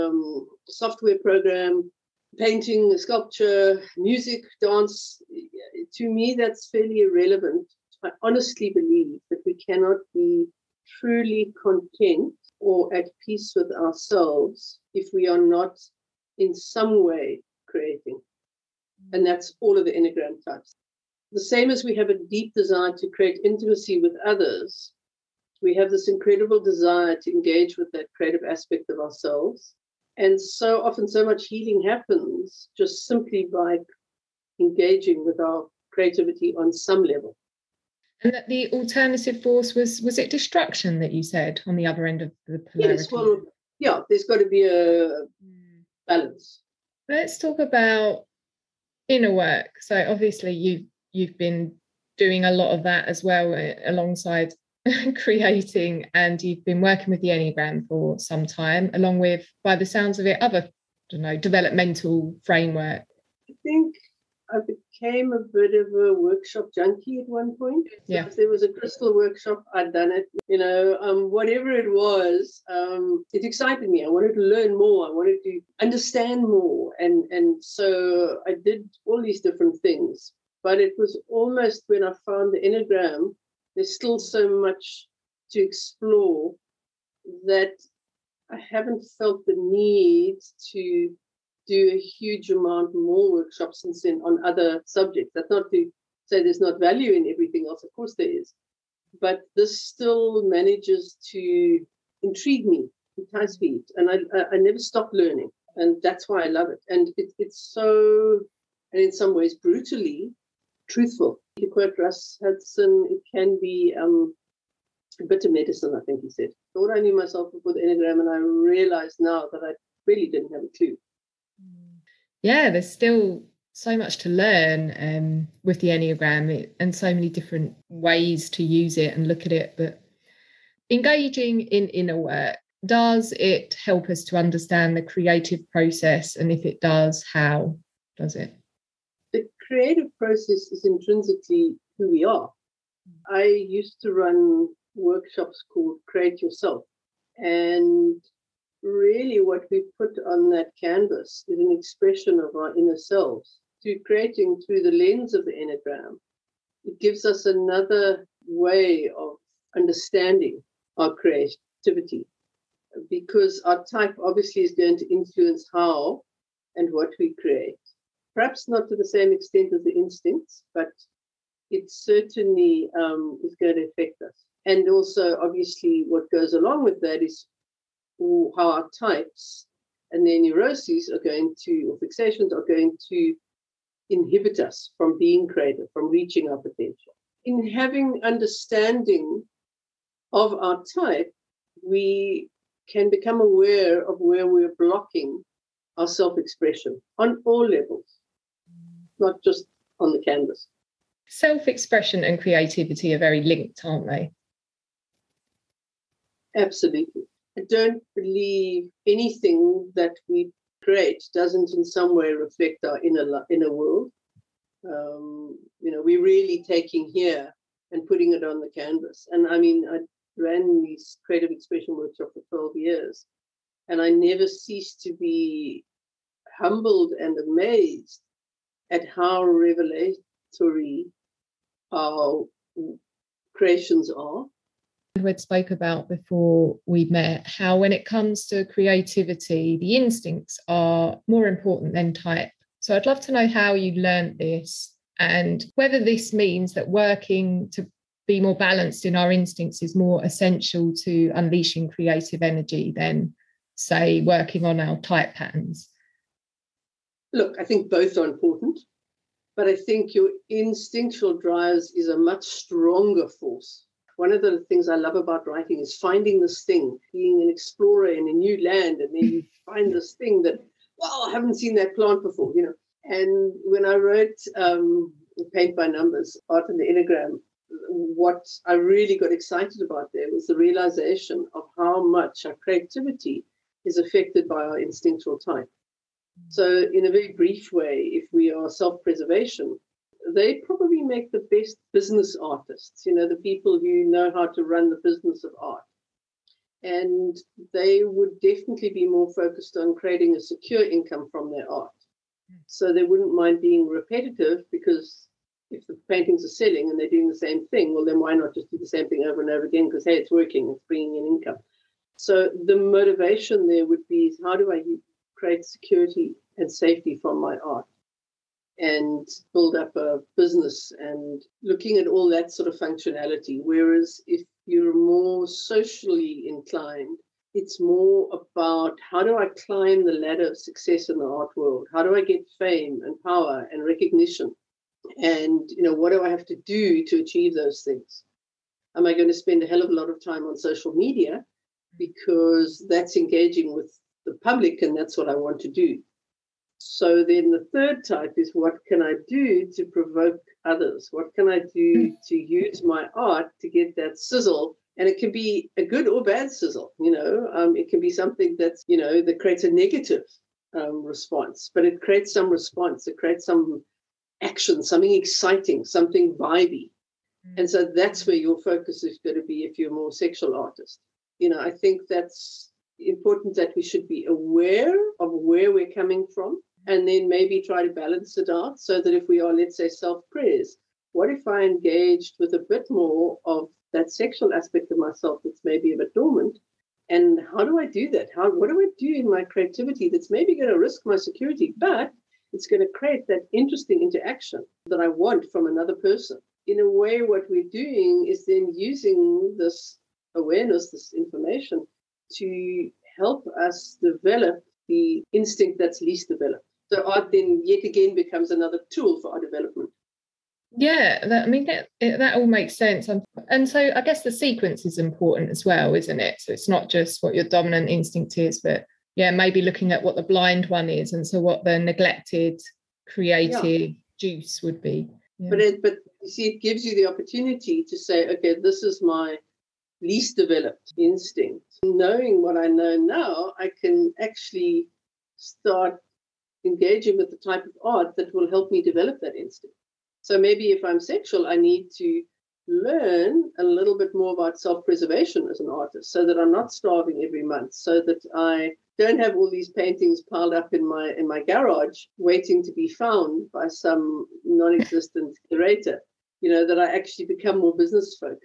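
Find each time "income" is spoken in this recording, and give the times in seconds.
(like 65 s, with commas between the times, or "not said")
300 s, 311 s.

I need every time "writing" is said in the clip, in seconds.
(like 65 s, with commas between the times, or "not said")
265 s.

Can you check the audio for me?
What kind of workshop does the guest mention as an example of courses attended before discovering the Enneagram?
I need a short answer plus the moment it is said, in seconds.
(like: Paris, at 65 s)
Crystal workshop, at 68 s.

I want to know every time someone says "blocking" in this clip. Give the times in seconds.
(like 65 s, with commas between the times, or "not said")
194 s.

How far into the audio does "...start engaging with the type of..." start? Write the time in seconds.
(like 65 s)
435 s.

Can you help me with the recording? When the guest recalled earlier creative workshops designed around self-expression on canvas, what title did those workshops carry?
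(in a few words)
Create Yourself.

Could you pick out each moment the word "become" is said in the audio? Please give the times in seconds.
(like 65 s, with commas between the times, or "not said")
193 s, 408 s, 457 s.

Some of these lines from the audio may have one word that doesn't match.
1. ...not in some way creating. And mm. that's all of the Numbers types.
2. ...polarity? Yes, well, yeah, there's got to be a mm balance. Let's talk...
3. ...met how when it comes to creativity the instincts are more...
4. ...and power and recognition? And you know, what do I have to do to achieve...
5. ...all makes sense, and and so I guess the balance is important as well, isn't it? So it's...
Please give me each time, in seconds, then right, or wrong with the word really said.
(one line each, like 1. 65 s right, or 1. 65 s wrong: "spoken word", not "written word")
1. 15 s wrong: "Enneagram", not "Numbers"
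2. 42 s right
3. 237 s right
4. 333 s right
5. 412 s wrong: "sequence", not "balance".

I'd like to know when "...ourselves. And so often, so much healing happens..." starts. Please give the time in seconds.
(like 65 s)
28 s.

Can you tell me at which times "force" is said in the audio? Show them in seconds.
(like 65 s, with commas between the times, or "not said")
39 s, 263 s.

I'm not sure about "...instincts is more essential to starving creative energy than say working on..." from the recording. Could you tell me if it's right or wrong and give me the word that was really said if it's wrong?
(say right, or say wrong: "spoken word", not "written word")
wrong: "unleashing", not "starving".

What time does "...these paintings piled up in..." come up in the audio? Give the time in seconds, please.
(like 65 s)
449 s.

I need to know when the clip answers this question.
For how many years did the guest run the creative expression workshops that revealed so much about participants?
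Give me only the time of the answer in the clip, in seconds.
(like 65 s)
222 s.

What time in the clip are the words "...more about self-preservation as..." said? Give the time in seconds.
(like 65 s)
444 s.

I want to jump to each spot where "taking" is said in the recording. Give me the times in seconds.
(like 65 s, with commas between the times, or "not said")
216 s.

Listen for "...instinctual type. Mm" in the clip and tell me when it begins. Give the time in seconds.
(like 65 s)
284 s.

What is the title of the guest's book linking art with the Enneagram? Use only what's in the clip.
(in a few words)
Paint by Numbers.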